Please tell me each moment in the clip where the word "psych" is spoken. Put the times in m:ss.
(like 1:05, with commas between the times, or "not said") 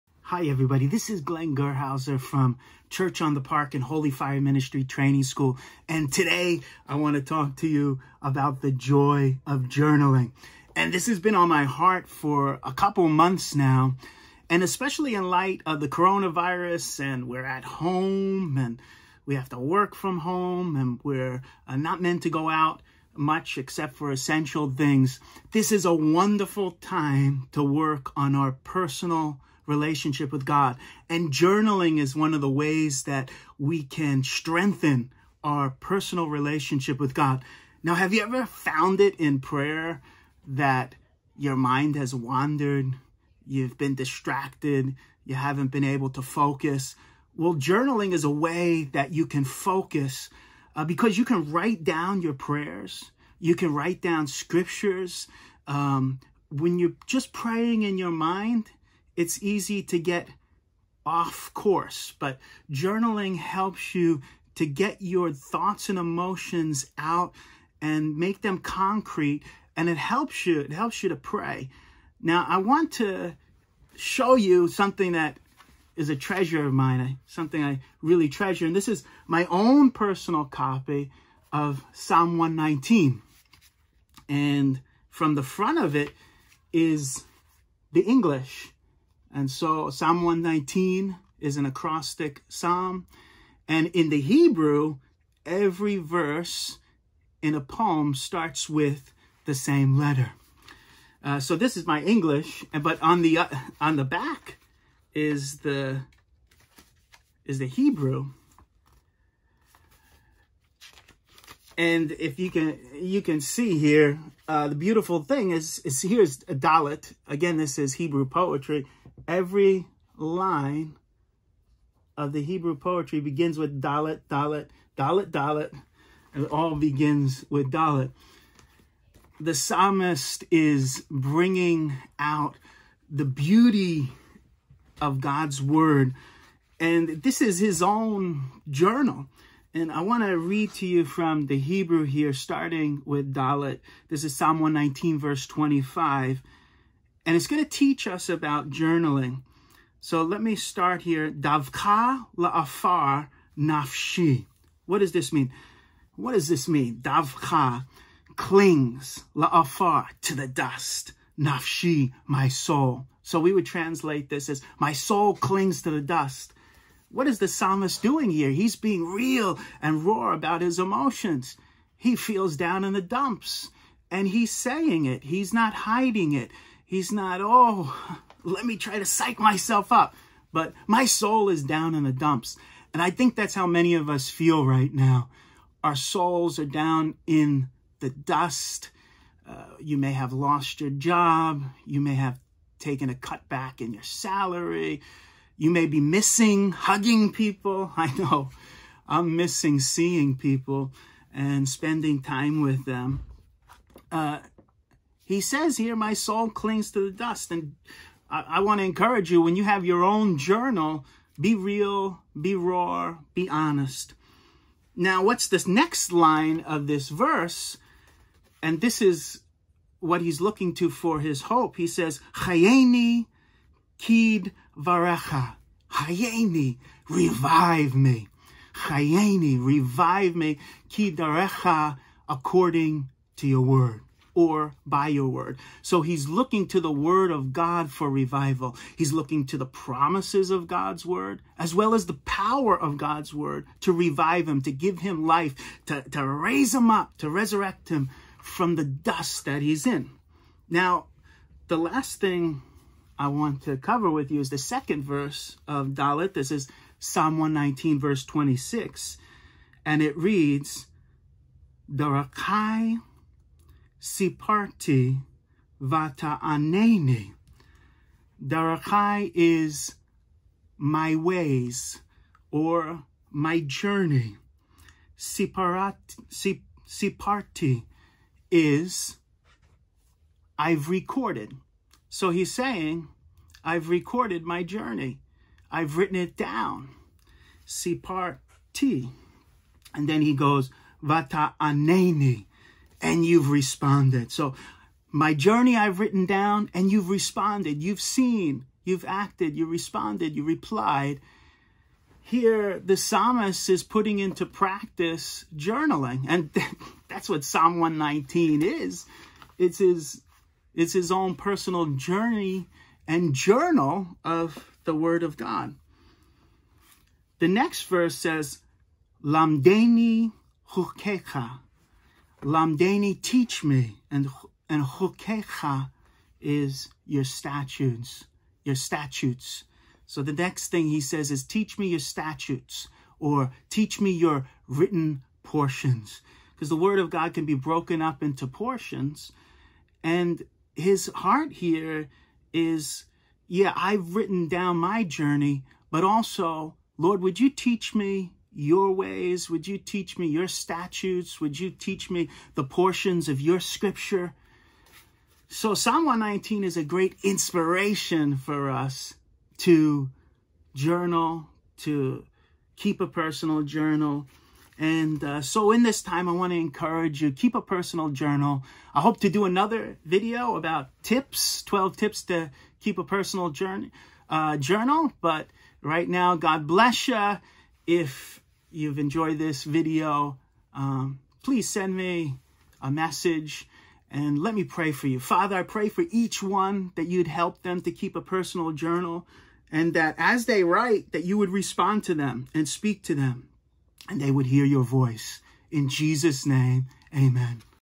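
2:59.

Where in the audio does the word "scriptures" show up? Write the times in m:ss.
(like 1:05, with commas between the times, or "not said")
0:54, 5:53.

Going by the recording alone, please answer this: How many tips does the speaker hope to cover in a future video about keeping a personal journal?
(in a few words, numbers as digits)
12.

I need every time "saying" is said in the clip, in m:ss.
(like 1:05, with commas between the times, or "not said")
2:54, 4:42.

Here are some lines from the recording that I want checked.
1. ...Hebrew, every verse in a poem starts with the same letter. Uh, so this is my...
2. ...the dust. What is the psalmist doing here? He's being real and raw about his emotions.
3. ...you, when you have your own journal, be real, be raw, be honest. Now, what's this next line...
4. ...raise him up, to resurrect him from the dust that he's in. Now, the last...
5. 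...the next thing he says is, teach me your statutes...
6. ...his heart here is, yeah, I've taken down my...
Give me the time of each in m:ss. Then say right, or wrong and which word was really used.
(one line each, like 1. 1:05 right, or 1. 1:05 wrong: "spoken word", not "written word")
1. 1:34 right
2. 2:45 right
3. 3:29 right
4. 4:06 right
5. 5:30 right
6. 5:40 wrong: "written", not "taken".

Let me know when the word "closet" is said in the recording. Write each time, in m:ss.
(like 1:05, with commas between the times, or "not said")
not said.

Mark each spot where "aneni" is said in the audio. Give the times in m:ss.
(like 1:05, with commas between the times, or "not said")
4:26, 4:51.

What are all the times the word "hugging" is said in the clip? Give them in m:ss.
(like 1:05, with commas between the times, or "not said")
3:16.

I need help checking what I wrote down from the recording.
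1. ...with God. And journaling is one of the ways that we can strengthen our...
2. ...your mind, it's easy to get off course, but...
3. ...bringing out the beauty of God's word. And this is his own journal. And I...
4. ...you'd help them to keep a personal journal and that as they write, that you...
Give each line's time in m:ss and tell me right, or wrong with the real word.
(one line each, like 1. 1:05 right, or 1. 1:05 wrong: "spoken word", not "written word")
1. 0:30 right
2. 0:57 right
3. 2:11 right
4. 6:27 right.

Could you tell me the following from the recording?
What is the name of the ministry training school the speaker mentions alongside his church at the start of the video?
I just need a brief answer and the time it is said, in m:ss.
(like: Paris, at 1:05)
Holy Fire Ministry Training School, at 0:03.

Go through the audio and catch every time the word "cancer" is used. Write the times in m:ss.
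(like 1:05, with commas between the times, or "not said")
not said.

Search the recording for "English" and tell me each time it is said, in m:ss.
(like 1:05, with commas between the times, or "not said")
1:28, 1:42.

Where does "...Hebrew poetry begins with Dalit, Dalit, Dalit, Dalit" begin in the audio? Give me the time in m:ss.
2:02.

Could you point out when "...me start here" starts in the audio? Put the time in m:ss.
2:30.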